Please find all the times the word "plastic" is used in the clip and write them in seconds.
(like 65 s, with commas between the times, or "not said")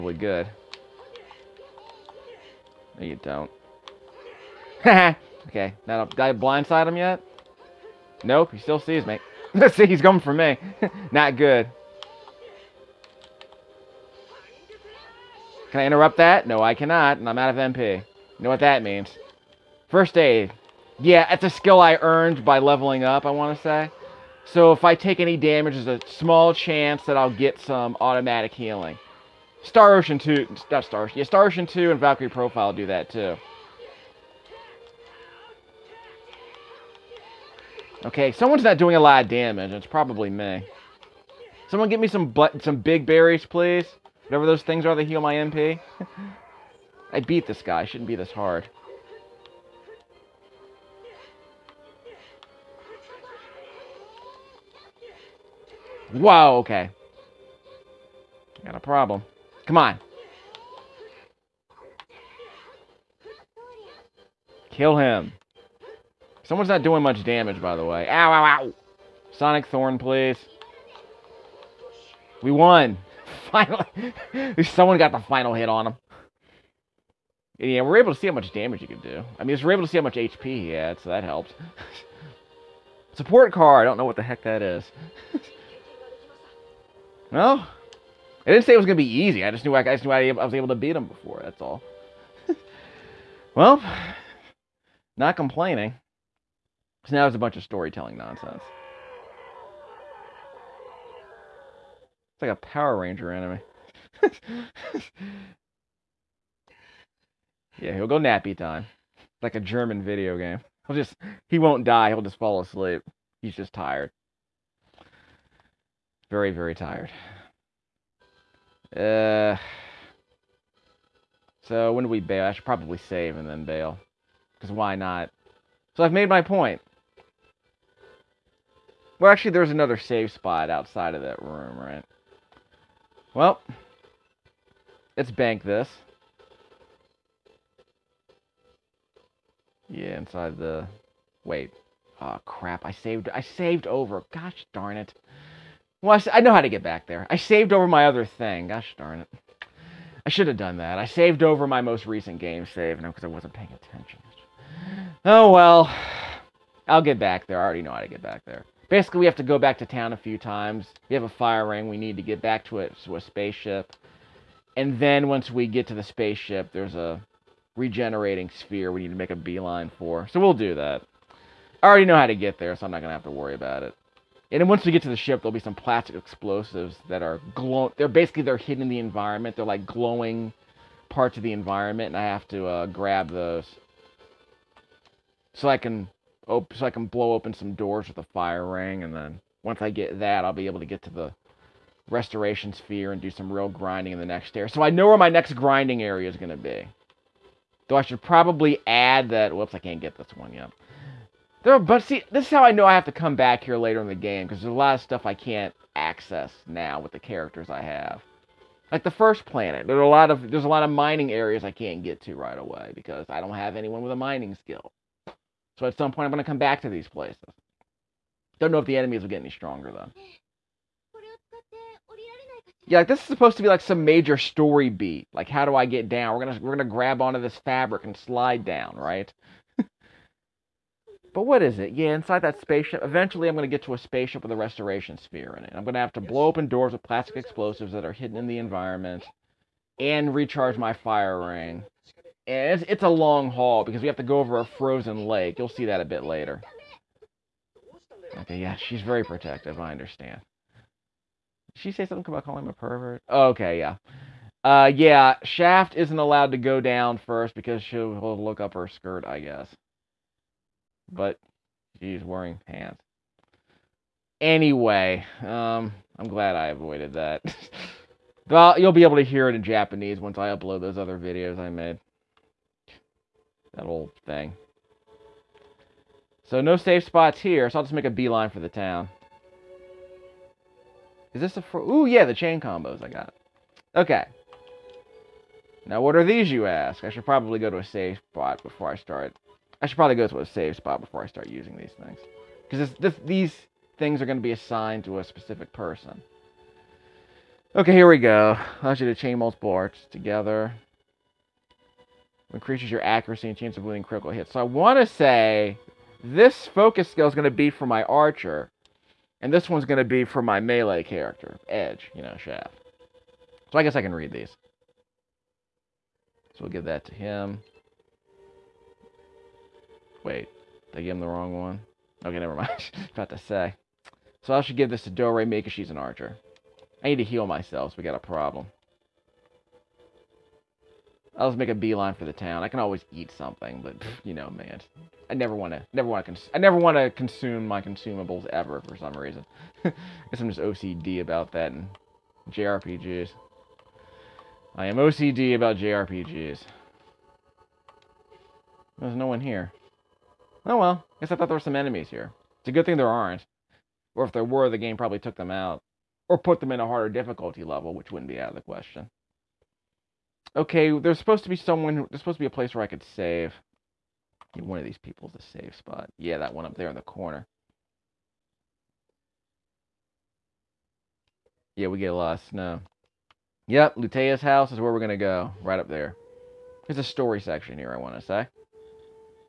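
175 s, 237 s.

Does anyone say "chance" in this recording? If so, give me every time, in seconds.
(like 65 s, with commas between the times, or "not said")
26 s, 303 s.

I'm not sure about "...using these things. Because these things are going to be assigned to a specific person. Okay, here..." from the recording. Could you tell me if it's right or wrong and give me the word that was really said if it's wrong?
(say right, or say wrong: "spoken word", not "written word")
right.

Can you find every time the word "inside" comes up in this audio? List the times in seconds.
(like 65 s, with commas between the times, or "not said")
140 s, 232 s.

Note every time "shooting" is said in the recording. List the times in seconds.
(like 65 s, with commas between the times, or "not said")
not said.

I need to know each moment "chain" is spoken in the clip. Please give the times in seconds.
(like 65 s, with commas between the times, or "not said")
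282 s, 299 s.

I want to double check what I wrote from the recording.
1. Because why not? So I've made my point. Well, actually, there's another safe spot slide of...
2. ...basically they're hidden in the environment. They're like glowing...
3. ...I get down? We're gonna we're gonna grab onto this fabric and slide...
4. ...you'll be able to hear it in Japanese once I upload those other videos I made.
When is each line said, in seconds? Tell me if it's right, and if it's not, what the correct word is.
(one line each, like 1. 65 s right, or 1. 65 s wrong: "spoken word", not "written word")
1. 124 s wrong: "outside", not "slide"
2. 178 s right
3. 225 s right
4. 268 s right.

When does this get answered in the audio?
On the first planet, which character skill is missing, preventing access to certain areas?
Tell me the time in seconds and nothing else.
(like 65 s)
214 s.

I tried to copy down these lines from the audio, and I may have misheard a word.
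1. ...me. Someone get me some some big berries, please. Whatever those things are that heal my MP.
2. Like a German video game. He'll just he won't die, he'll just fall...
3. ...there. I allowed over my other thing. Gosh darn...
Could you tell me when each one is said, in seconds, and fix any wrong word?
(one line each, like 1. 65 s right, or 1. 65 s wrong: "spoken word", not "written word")
1. 40 s right
2. 109 s right
3. 147 s wrong: "saved", not "allowed".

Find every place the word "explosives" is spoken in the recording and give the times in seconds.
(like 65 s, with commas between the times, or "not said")
176 s, 237 s.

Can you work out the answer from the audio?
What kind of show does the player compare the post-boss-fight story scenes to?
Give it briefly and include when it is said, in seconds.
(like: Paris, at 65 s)
Power Ranger anime, at 102 s.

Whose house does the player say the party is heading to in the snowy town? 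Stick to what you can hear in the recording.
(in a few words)
Lutea's.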